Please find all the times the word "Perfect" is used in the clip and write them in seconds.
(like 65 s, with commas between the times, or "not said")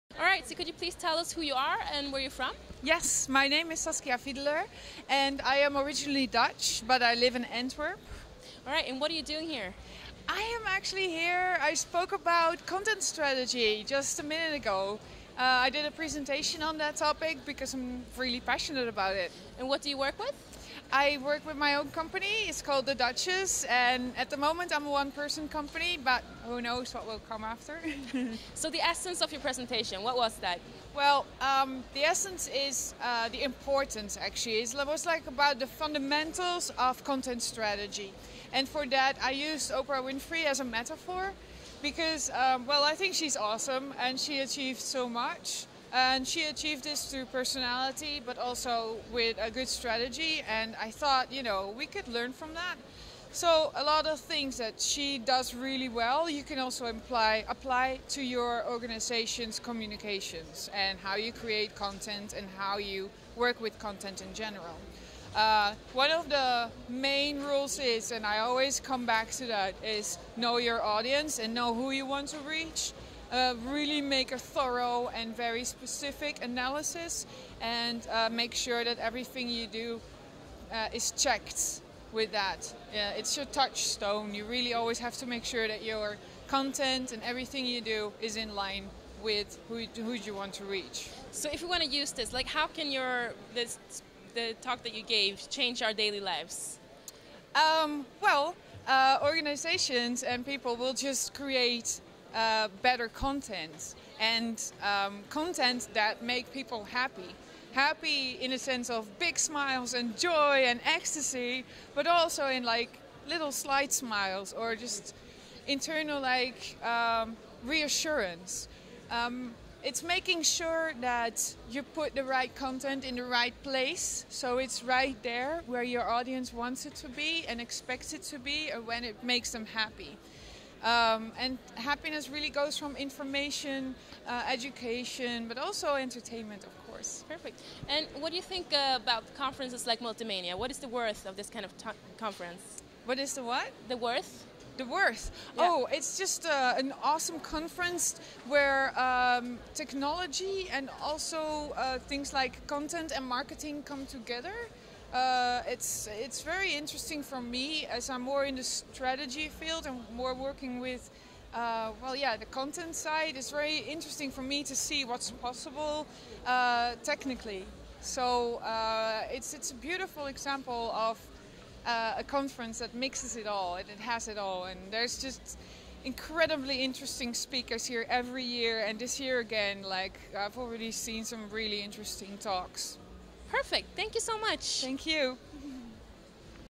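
137 s, 183 s.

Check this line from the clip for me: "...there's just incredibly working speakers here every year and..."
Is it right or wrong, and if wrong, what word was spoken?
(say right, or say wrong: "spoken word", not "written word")
wrong: "interesting", not "working".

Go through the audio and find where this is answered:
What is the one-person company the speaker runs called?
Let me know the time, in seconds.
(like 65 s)
22 s.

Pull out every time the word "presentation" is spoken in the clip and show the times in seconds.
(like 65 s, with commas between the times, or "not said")
15 s, 29 s.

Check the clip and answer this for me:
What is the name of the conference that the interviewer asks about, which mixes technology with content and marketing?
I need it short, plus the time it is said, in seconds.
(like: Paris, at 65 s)
Multi-Mania, at 140 s.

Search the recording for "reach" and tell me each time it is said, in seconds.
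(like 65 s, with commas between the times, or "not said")
72 s, 90 s.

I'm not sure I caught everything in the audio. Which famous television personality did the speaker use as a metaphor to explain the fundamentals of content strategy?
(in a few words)
Oprah Winfrey.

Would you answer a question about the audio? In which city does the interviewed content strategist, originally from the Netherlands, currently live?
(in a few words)
Antwerp.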